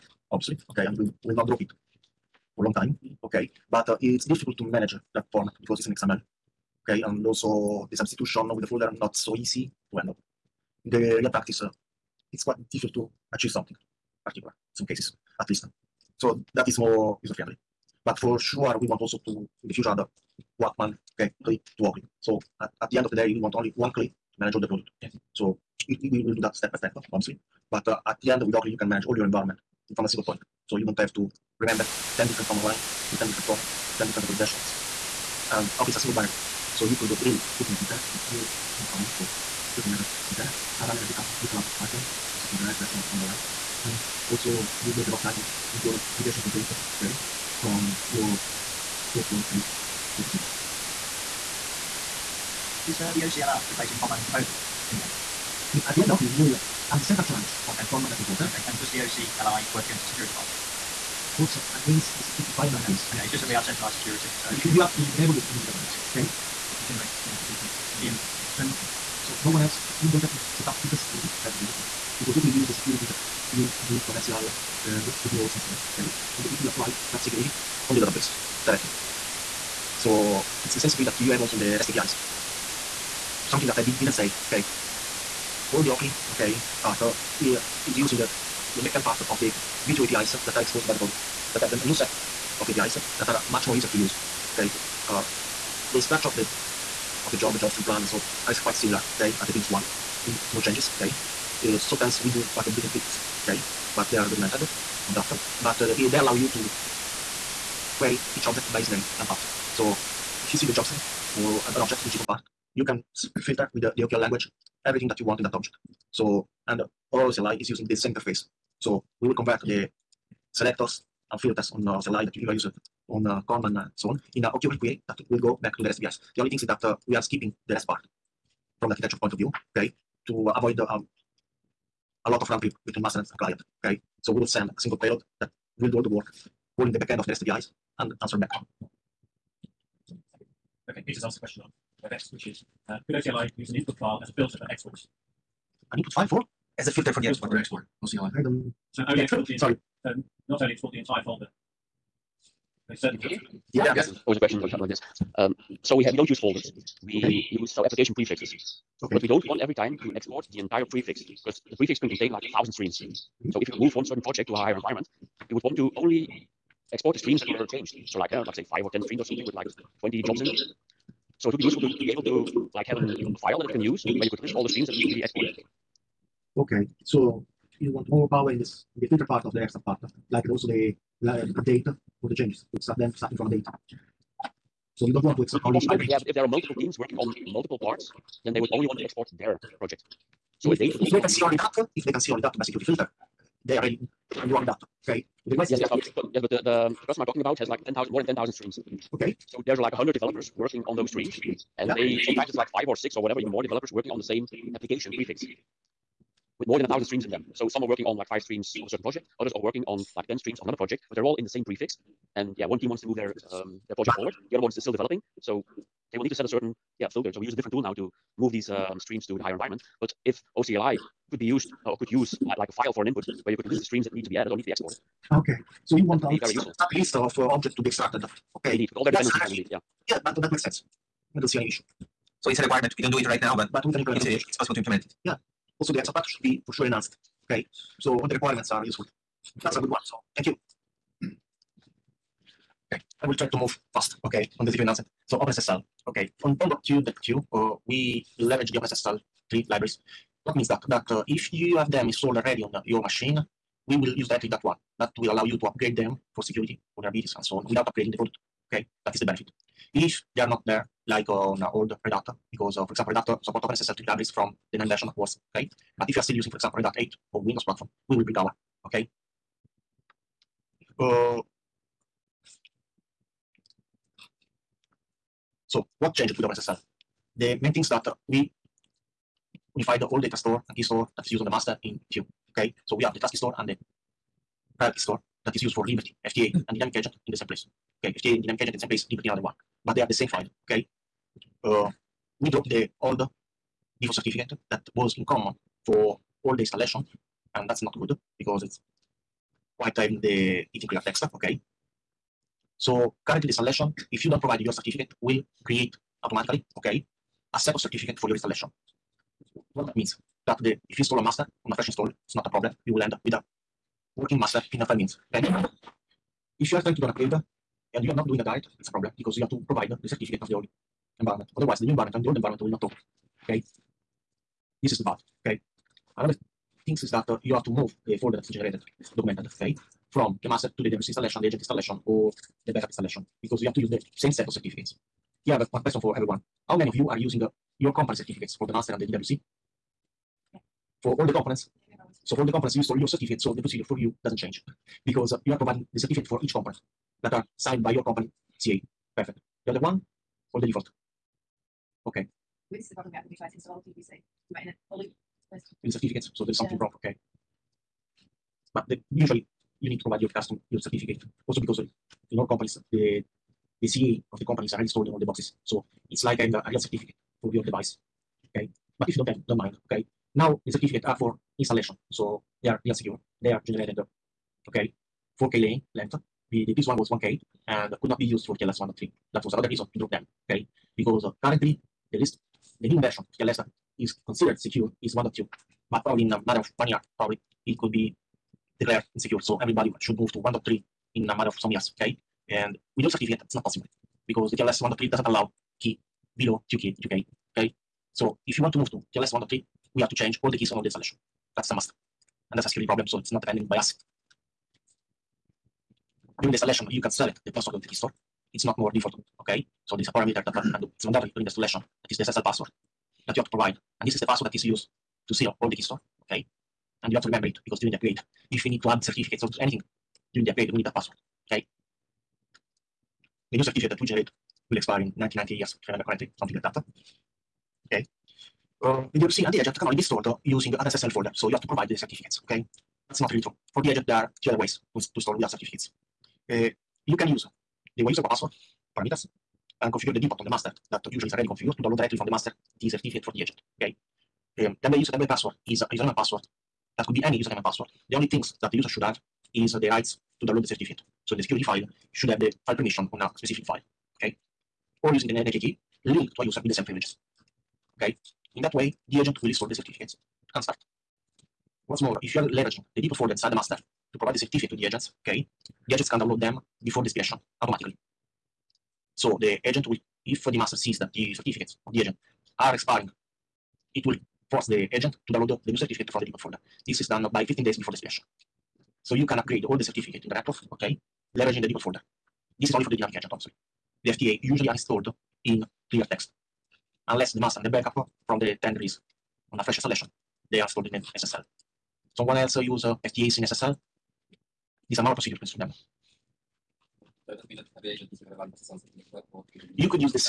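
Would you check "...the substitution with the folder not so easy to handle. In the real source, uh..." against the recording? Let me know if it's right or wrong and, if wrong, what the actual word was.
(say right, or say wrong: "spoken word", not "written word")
wrong: "practice", not "source".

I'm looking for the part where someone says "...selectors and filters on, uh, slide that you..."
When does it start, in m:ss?
2:00.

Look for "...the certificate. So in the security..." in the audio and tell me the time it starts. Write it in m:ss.
7:30.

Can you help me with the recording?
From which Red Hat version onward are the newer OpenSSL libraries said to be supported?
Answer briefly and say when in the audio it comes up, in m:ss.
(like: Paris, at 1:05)
9, at 4:24.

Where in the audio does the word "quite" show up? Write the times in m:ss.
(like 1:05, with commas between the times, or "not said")
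0:12, 1:38, 4:59.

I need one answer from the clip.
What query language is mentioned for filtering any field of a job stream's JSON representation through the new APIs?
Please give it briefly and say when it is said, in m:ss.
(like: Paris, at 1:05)
OQL, at 1:54.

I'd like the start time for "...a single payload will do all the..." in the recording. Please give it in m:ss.
2:14.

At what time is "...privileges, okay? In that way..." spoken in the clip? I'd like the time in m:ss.
7:36.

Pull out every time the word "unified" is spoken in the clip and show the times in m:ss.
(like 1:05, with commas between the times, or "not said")
4:39.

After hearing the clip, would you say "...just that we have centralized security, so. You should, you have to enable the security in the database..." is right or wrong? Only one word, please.
right.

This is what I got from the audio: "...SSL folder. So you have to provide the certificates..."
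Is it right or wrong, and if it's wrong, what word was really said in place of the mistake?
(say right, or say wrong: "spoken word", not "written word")
right.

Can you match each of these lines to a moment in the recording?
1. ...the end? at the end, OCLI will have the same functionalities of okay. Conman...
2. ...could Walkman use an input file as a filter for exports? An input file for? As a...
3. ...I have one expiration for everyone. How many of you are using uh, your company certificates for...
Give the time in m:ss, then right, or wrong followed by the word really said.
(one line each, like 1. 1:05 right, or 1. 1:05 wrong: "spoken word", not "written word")
1. 0:54 right
2. 2:23 wrong: "OCLI", not "Walkman"
3. 5:35 wrong: "question", not "expiration".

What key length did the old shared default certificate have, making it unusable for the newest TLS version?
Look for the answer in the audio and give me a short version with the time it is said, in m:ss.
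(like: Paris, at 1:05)
1K, at 6:17.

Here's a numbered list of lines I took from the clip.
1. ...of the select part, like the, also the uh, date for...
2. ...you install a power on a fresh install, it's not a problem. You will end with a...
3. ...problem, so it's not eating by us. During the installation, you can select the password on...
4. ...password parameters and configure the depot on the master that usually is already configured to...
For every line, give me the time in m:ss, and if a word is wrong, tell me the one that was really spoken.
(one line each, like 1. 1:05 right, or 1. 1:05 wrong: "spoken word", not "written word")
1. 2:59 wrong: "extract", not "select"
2. 5:10 wrong: "master", not "power"
3. 6:42 wrong: "depending", not "eating"
4. 7:18 right.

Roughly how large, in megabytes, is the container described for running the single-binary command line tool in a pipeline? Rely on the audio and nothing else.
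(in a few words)
30.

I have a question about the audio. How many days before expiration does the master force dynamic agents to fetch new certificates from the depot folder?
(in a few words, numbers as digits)
15.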